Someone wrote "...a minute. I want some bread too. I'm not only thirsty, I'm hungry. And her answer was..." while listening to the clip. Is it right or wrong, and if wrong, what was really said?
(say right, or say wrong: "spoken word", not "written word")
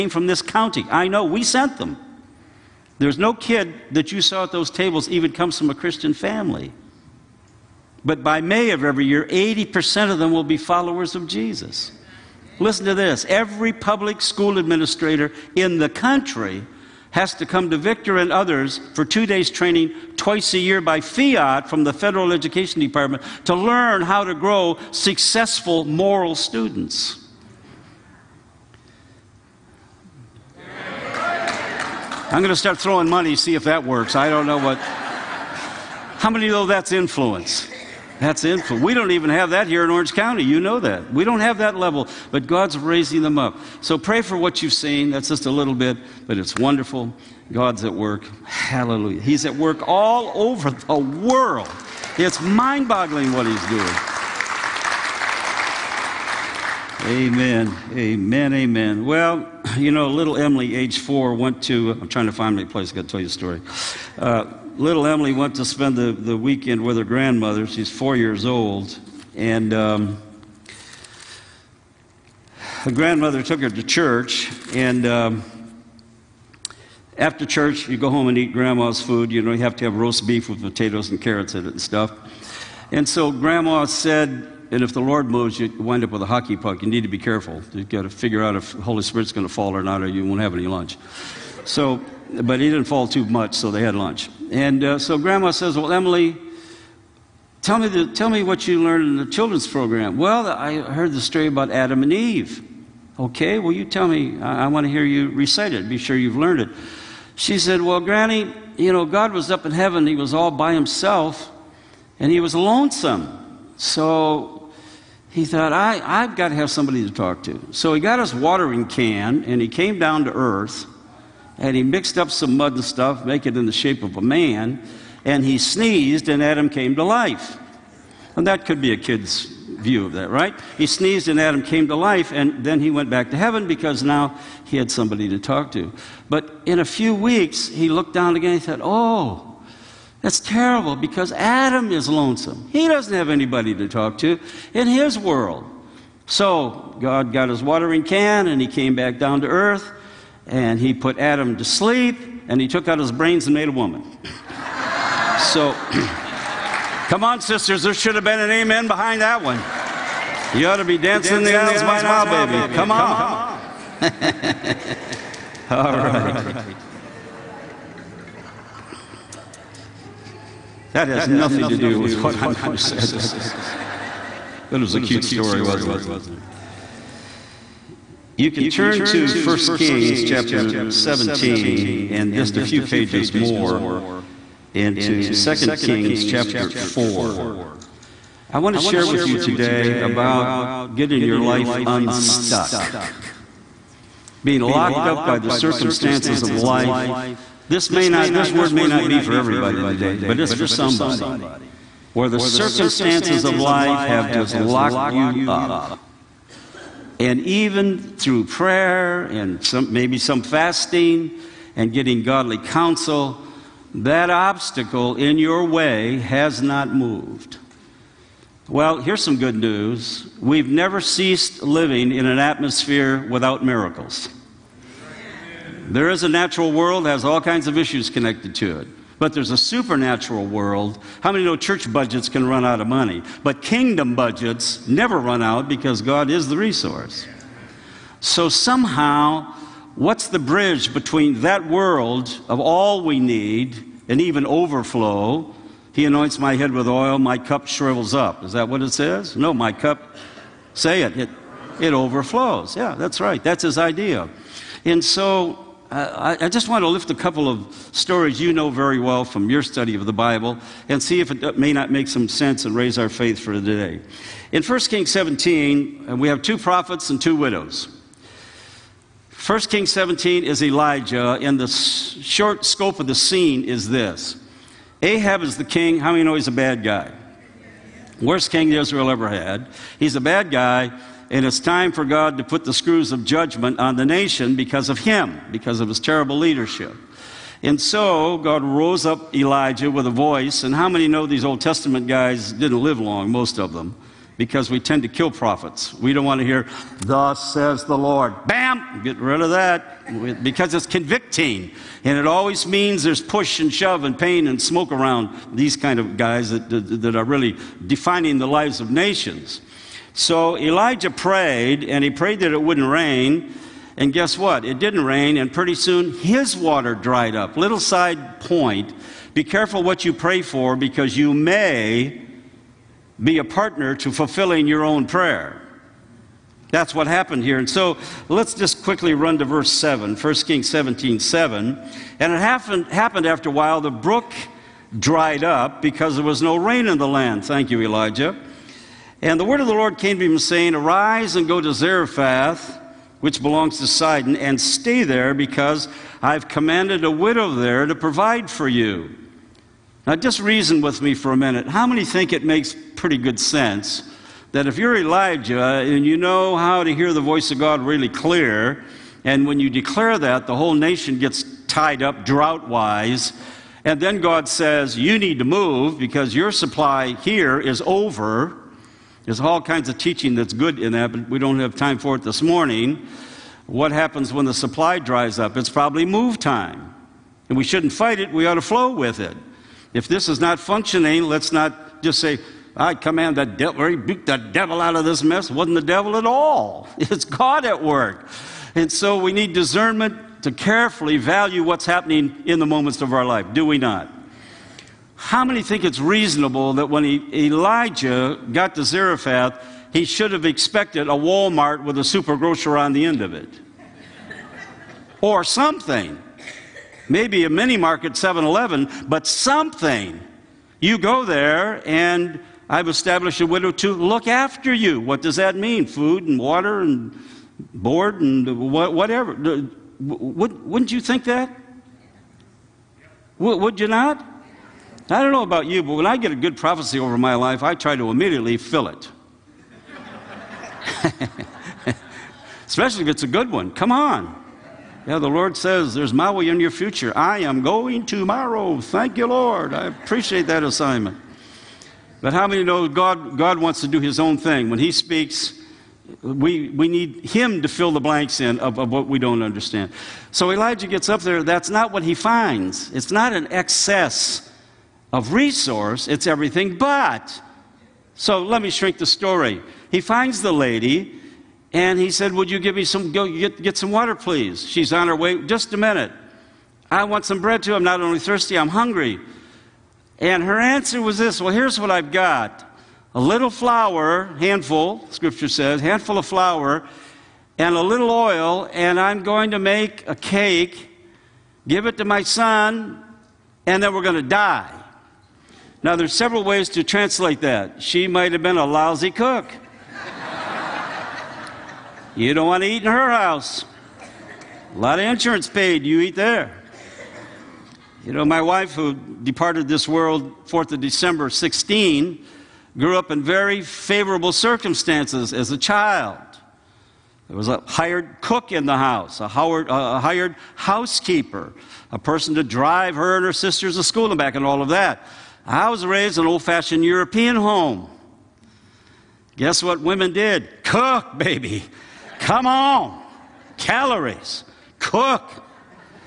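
right.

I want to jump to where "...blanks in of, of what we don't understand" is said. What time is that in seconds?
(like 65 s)
448 s.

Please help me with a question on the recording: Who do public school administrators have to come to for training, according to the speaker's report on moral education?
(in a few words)
Victor.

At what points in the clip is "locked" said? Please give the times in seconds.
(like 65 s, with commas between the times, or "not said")
194 s, 204 s.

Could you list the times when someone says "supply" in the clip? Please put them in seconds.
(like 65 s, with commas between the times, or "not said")
366 s, 374 s.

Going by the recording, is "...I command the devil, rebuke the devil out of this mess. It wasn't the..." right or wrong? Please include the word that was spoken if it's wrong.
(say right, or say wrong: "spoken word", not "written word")
right.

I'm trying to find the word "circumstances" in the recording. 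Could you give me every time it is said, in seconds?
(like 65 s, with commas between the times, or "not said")
195 s, 202 s, 504 s.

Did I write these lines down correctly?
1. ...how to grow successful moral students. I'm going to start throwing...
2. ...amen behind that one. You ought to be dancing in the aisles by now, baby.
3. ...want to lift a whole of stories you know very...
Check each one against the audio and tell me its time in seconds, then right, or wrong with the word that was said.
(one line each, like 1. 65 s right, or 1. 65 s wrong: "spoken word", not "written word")
1. 24 s right
2. 158 s right
3. 256 s wrong: "couple", not "whole".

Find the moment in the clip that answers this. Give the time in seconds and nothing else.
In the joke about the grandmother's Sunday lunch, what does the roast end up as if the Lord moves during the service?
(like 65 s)
86 s.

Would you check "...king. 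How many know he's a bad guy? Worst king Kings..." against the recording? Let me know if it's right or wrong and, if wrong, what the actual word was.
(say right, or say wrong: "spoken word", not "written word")
wrong: "Israel", not "Kings".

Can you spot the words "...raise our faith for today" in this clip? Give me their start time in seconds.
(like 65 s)
262 s.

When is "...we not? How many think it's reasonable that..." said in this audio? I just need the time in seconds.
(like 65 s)
393 s.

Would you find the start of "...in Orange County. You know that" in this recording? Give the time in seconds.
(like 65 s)
39 s.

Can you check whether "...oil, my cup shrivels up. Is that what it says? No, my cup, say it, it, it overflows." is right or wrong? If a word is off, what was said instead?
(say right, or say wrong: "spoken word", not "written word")
right.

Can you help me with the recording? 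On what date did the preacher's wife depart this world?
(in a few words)
4th of December.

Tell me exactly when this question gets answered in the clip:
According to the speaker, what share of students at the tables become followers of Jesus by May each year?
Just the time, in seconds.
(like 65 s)
9 s.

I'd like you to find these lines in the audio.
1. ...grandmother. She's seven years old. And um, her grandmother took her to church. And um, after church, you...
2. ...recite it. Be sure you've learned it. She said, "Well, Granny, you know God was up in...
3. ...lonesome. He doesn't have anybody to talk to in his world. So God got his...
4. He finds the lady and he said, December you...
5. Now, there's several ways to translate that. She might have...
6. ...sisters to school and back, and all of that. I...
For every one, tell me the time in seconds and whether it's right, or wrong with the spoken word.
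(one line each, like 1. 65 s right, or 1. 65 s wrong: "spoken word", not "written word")
1. 67 s wrong: "four", not "seven"
2. 105 s right
3. 142 s right
4. 459 s wrong: "Would", not "December"
5. 485 s right
6. 513 s right.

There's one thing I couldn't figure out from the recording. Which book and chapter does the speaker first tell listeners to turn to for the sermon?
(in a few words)
1 Kings 17.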